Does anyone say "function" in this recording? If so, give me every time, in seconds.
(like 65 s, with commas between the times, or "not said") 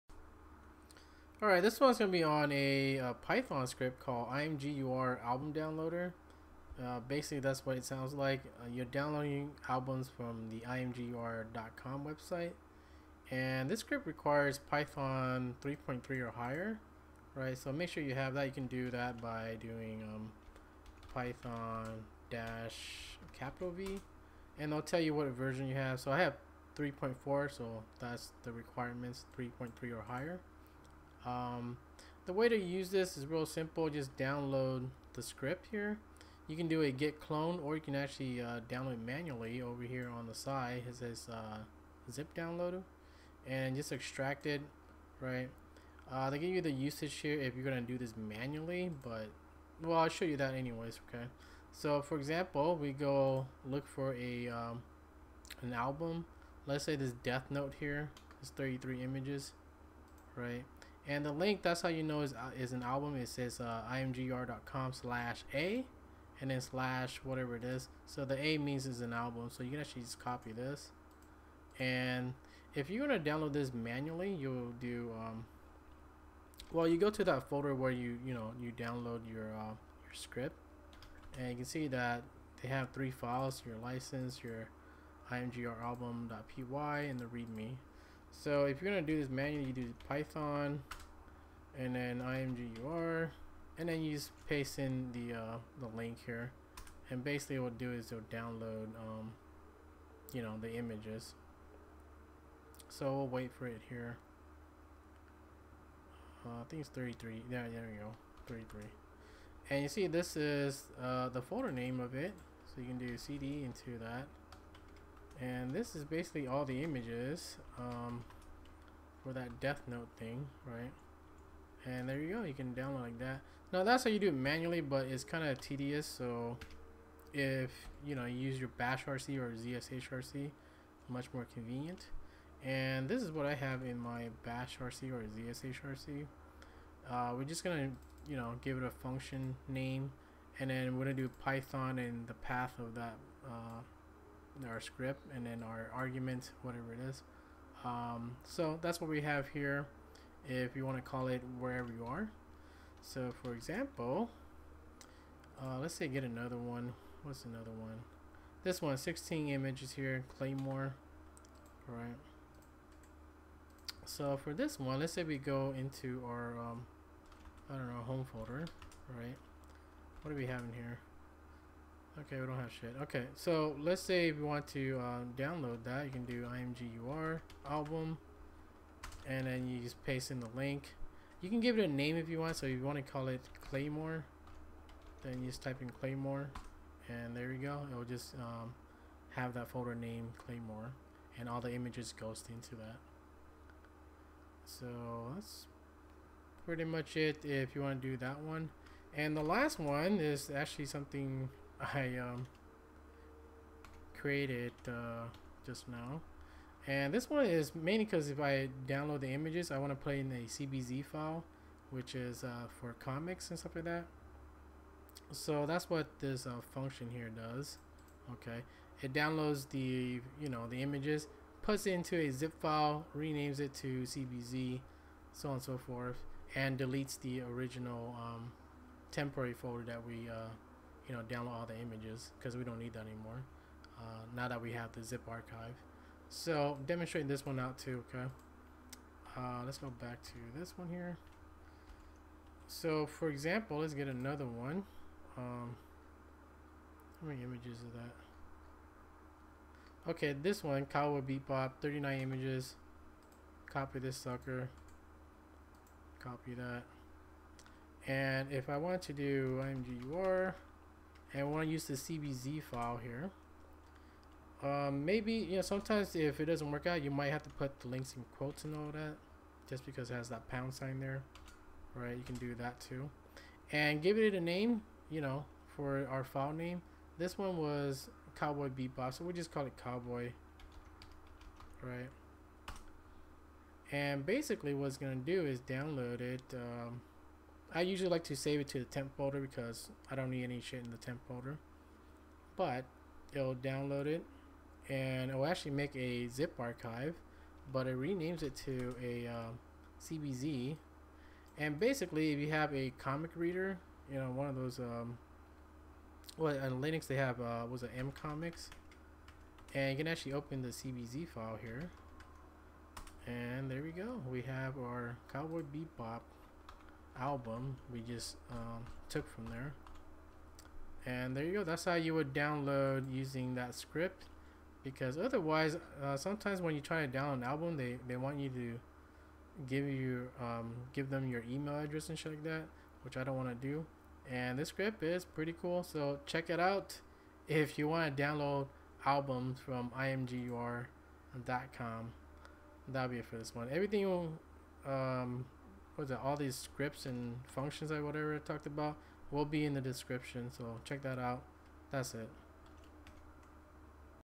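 138 s, 216 s, 347 s.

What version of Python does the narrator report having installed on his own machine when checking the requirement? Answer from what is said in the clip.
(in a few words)
3.4.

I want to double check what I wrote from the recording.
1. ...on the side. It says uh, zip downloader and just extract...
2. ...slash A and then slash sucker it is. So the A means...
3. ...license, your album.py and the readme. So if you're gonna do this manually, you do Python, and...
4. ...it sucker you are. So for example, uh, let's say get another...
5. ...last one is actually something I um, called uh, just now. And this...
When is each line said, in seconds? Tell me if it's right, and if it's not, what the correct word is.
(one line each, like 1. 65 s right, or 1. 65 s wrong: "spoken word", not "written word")
1. 40 s right
2. 64 s wrong: "whatever", not "sucker"
3. 83 s right
4. 151 s wrong: "wherever", not "sucker"
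5. 199 s wrong: "created", not "called".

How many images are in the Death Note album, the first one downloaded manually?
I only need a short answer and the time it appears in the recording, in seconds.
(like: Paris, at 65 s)
33, at 58 s.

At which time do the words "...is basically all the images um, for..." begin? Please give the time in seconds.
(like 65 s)
115 s.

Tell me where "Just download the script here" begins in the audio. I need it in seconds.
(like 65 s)
33 s.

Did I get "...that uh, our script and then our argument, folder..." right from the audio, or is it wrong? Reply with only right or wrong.
wrong.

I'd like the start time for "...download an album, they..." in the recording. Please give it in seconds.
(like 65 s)
327 s.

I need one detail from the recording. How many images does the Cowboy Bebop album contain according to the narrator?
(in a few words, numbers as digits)
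39.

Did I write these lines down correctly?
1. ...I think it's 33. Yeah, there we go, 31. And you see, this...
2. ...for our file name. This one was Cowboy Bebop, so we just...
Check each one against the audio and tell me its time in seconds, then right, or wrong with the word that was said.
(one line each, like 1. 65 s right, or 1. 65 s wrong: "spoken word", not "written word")
1. 106 s wrong: "33", not "31"
2. 275 s right.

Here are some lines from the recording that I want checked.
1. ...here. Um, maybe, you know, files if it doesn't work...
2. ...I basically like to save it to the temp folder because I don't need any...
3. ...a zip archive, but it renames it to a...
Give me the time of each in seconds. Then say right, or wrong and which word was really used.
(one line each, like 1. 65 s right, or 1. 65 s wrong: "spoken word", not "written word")
1. 263 s wrong: "sometimes", not "files"
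2. 287 s wrong: "usually", not "basically"
3. 295 s right.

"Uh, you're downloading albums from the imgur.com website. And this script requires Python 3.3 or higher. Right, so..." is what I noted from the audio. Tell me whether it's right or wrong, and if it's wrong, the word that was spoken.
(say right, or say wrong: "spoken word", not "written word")
right.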